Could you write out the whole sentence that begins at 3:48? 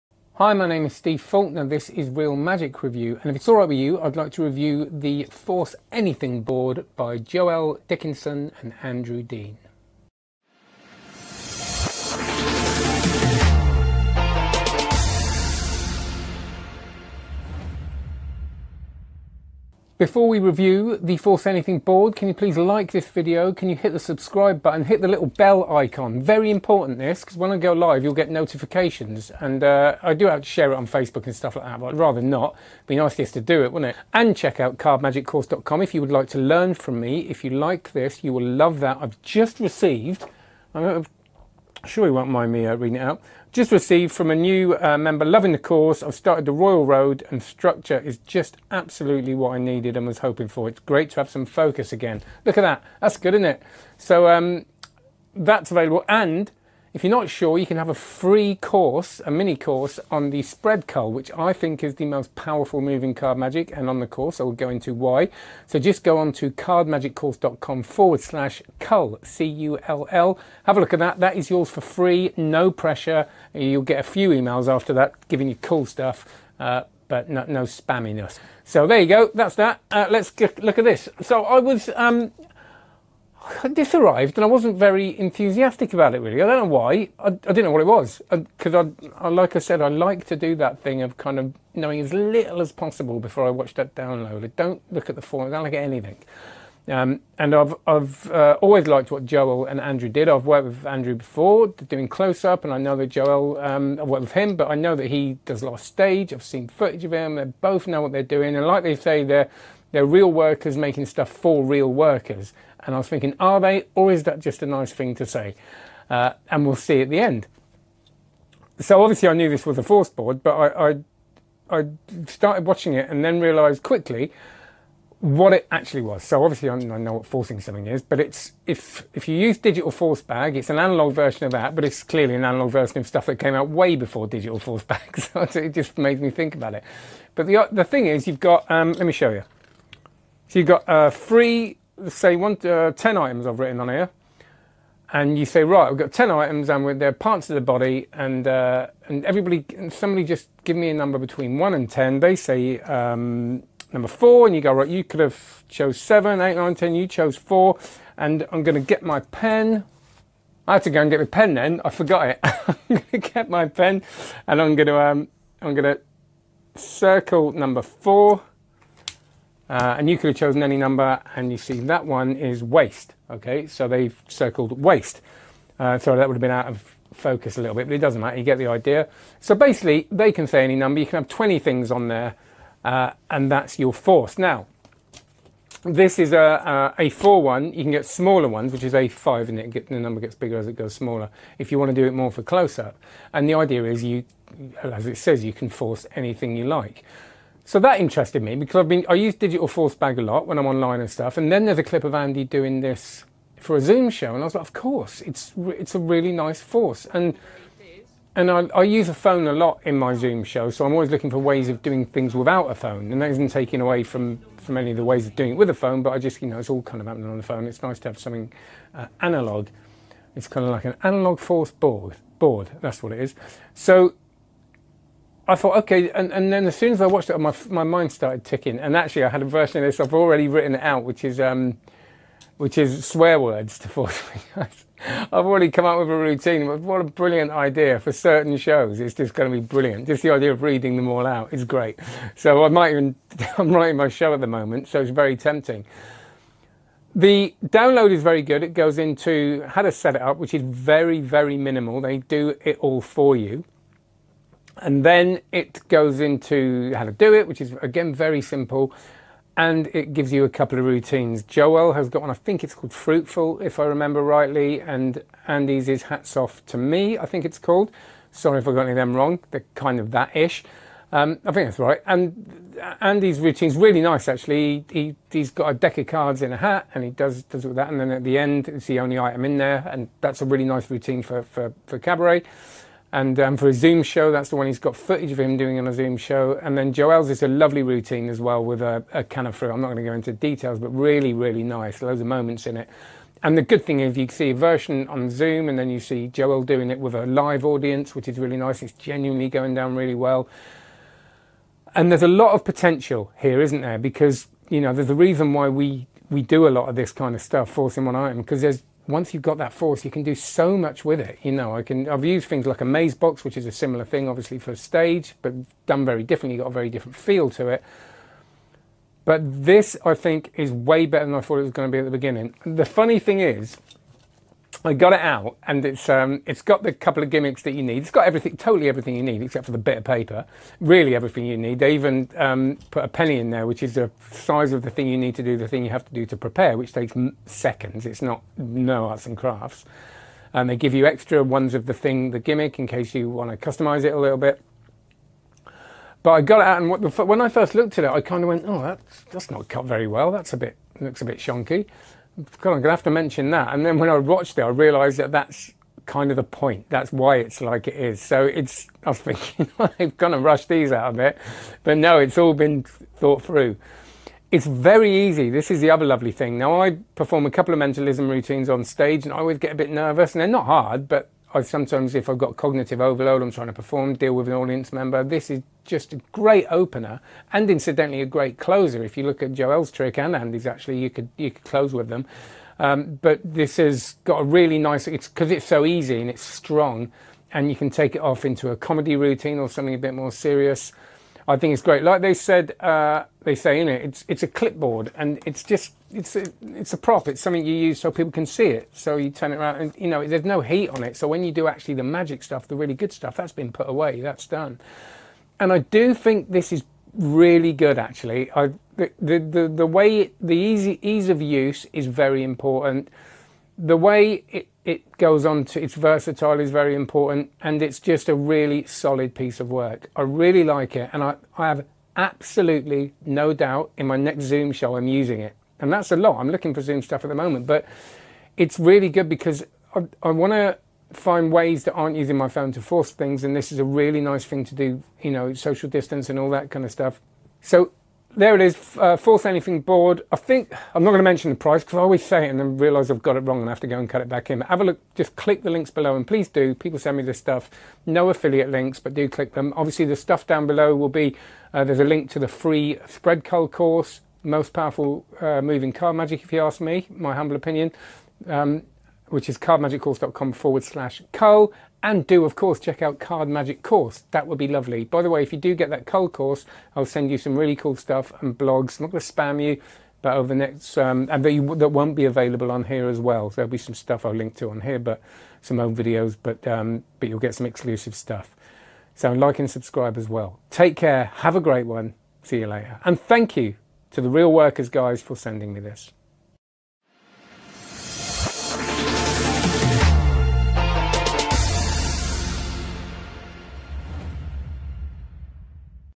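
And actually, I had a version of this.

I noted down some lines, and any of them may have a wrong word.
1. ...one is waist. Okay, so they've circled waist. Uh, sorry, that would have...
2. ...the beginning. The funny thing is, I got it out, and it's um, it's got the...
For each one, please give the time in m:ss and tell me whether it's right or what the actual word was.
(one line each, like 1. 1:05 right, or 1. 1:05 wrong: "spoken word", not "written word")
1. 2:52 right
2. 5:22 right.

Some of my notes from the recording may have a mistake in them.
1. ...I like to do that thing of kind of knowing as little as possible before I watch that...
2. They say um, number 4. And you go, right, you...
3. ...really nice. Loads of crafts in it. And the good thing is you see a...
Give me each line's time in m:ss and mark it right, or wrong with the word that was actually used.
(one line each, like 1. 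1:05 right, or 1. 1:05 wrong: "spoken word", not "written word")
1. 1:29 right
2. 2:32 right
3. 4:51 wrong: "moments", not "crafts".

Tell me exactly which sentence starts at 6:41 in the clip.
So when you do actually the magic stuff, the really good stuff, that's been put away.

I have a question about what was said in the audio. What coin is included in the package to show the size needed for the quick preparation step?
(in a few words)
A penny.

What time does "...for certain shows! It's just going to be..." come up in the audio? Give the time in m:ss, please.
3:57.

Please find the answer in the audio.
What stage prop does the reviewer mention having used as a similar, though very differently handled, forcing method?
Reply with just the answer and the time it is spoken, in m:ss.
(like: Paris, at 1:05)
A maze box, at 5:12.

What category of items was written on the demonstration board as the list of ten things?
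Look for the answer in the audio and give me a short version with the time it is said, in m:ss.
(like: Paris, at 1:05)
Parts of the body, at 2:27.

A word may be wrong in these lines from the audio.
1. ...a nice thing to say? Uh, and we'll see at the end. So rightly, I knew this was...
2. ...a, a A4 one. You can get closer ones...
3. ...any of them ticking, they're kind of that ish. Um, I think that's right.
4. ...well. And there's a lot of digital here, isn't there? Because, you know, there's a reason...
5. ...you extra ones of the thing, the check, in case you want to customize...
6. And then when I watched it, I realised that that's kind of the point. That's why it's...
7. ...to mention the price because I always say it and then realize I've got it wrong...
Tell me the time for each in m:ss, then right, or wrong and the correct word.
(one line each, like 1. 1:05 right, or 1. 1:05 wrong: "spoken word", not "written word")
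1. 1:54 wrong: "obviously", not "rightly"
2. 3:06 wrong: "smaller", not "closer"
3. 4:28 wrong: "wrong", not "ticking"
4. 5:00 wrong: "potential", not "digital"
5. 5:40 wrong: "gimmick", not "check"
6. 5:53 right
7. 7:21 right.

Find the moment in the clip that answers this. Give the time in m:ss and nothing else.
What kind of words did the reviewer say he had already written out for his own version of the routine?
3:53.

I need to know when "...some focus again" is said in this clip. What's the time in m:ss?
0:51.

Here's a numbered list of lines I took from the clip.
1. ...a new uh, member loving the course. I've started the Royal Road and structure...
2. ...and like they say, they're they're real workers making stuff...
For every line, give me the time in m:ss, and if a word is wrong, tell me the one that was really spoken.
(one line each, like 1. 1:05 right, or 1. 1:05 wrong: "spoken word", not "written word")
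1. 0:44 right
2. 1:48 right.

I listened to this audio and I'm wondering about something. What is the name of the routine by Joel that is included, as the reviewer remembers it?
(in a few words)
Fruitful.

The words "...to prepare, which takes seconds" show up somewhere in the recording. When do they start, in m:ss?
5:36.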